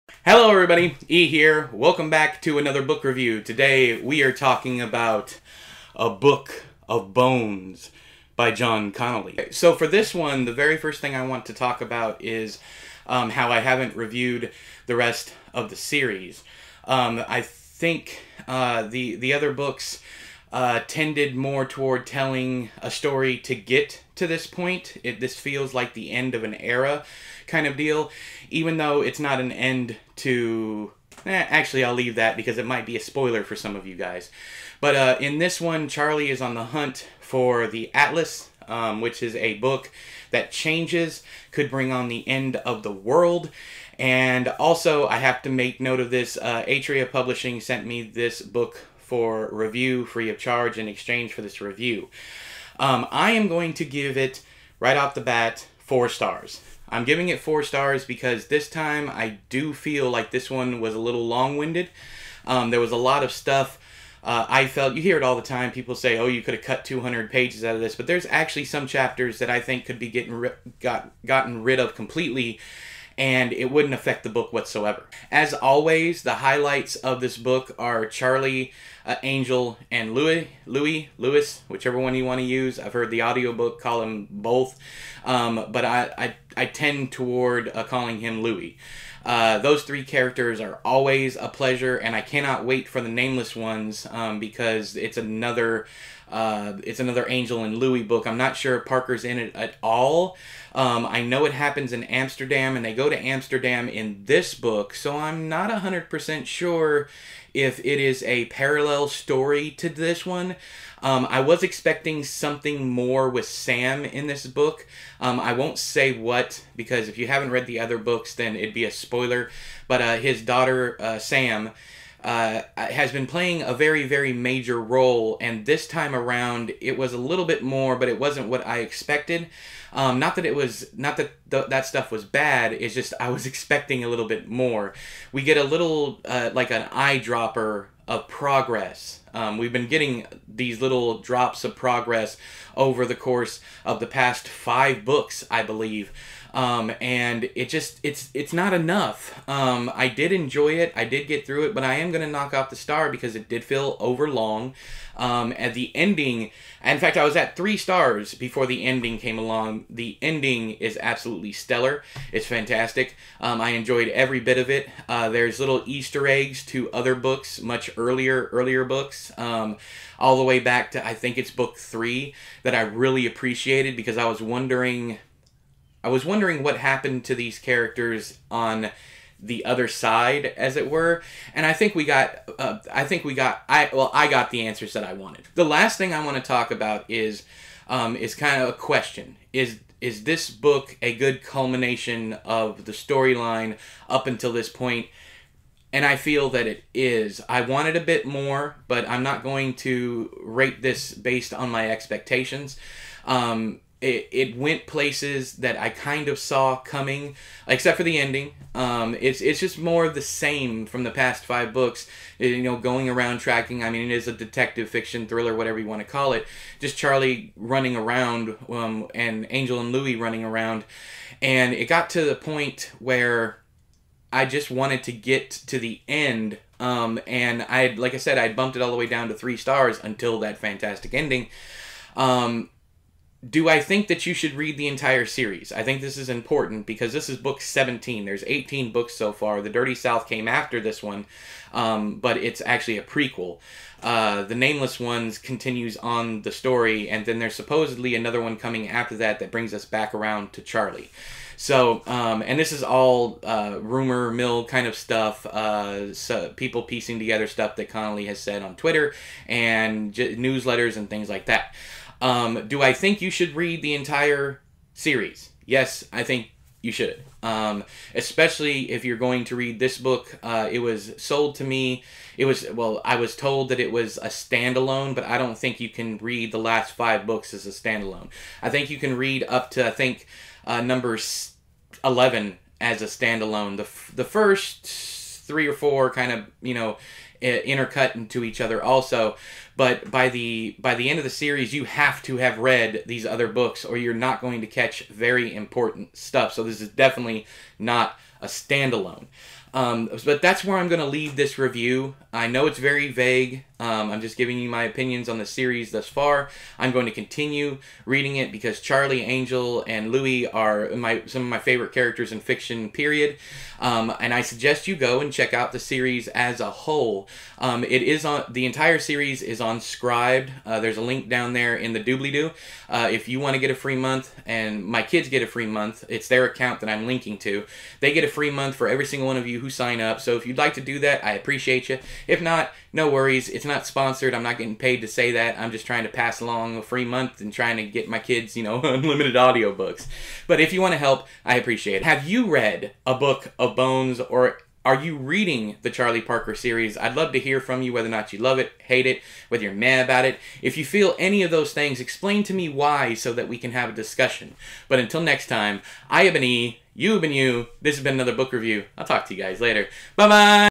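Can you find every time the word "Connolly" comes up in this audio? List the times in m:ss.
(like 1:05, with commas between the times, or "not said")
0:08, 4:17.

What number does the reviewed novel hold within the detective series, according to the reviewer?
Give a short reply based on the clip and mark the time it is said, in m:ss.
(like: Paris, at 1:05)
17, at 3:57.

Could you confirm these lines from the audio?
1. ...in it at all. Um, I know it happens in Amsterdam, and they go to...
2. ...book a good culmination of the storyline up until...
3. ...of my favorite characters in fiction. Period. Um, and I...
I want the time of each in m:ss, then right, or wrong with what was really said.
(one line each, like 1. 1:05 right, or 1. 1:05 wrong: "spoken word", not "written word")
1. 1:39 right
2. 3:10 right
3. 5:11 right.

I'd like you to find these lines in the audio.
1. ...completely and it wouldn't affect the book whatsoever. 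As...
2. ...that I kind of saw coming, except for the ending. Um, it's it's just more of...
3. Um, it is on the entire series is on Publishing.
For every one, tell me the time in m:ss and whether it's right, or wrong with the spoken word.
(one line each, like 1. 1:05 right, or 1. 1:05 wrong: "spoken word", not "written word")
1. 1:11 right
2. 3:25 right
3. 5:17 wrong: "Scribd", not "Publishing".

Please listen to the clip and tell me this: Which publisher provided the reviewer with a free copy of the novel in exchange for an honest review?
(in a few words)
Atria Publishing.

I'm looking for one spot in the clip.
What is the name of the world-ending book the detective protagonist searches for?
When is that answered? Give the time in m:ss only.
0:37.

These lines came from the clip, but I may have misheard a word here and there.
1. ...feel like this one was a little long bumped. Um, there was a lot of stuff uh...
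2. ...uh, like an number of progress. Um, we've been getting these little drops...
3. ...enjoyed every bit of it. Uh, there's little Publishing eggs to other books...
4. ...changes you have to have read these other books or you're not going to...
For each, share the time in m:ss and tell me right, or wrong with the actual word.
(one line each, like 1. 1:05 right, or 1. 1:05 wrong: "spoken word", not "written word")
1. 0:59 wrong: "winded", not "bumped"
2. 2:16 wrong: "eyedropper", not "number"
3. 2:43 wrong: "Easter", not "Publishing"
4. 4:51 wrong: "series", not "changes".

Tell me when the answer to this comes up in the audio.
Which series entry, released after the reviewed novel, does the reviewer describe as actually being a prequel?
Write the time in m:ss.
3:59.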